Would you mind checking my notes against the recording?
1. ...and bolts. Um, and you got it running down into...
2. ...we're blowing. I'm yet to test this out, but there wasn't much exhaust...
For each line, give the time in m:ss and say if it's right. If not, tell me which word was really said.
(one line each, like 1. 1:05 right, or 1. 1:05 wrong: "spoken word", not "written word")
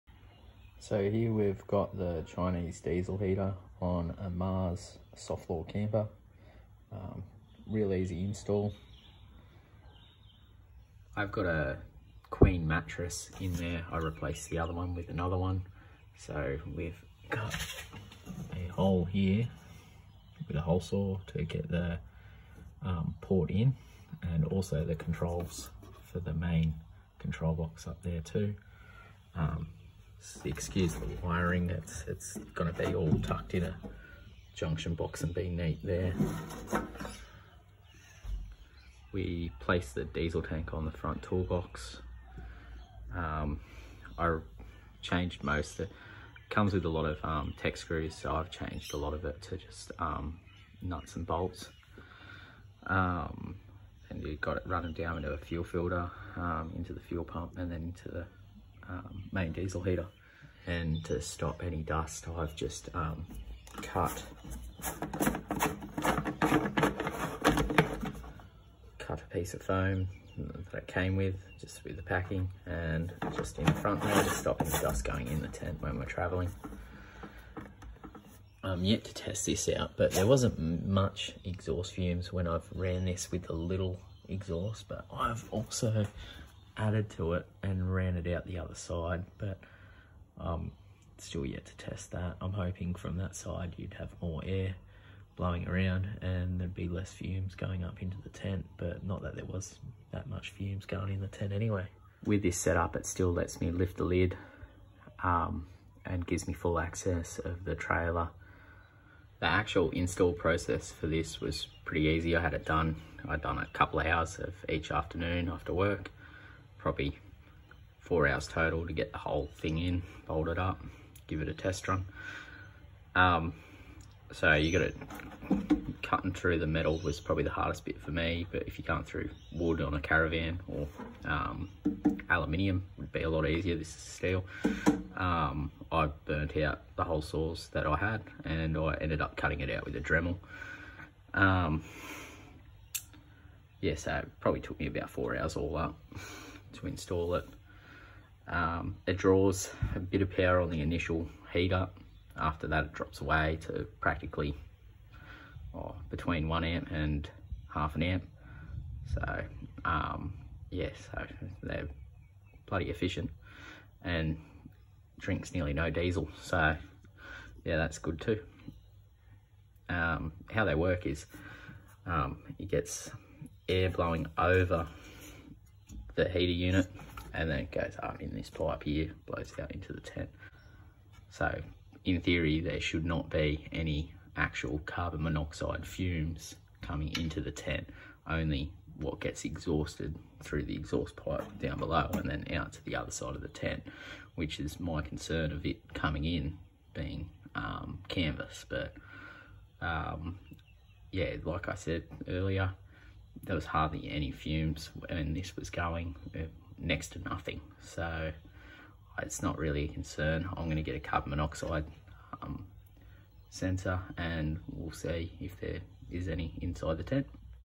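1. 0:51 right
2. 1:15 wrong: "traveling", not "blowing".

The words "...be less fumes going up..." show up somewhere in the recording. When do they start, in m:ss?
1:36.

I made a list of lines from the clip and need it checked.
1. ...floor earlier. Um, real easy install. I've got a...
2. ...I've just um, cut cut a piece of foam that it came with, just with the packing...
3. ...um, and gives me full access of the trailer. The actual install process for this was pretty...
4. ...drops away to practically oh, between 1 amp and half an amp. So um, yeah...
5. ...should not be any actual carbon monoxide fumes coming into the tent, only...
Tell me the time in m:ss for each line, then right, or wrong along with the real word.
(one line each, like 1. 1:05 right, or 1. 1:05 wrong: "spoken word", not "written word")
1. 0:05 wrong: "camper", not "earlier"
2. 1:02 right
3. 1:45 right
4. 2:32 right
5. 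3:02 right.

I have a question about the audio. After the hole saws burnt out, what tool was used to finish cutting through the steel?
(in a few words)
Dremel.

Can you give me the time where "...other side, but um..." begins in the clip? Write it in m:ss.
1:28.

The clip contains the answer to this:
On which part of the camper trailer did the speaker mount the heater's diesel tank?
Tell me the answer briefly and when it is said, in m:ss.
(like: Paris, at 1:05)
front toolbox, at 0:40.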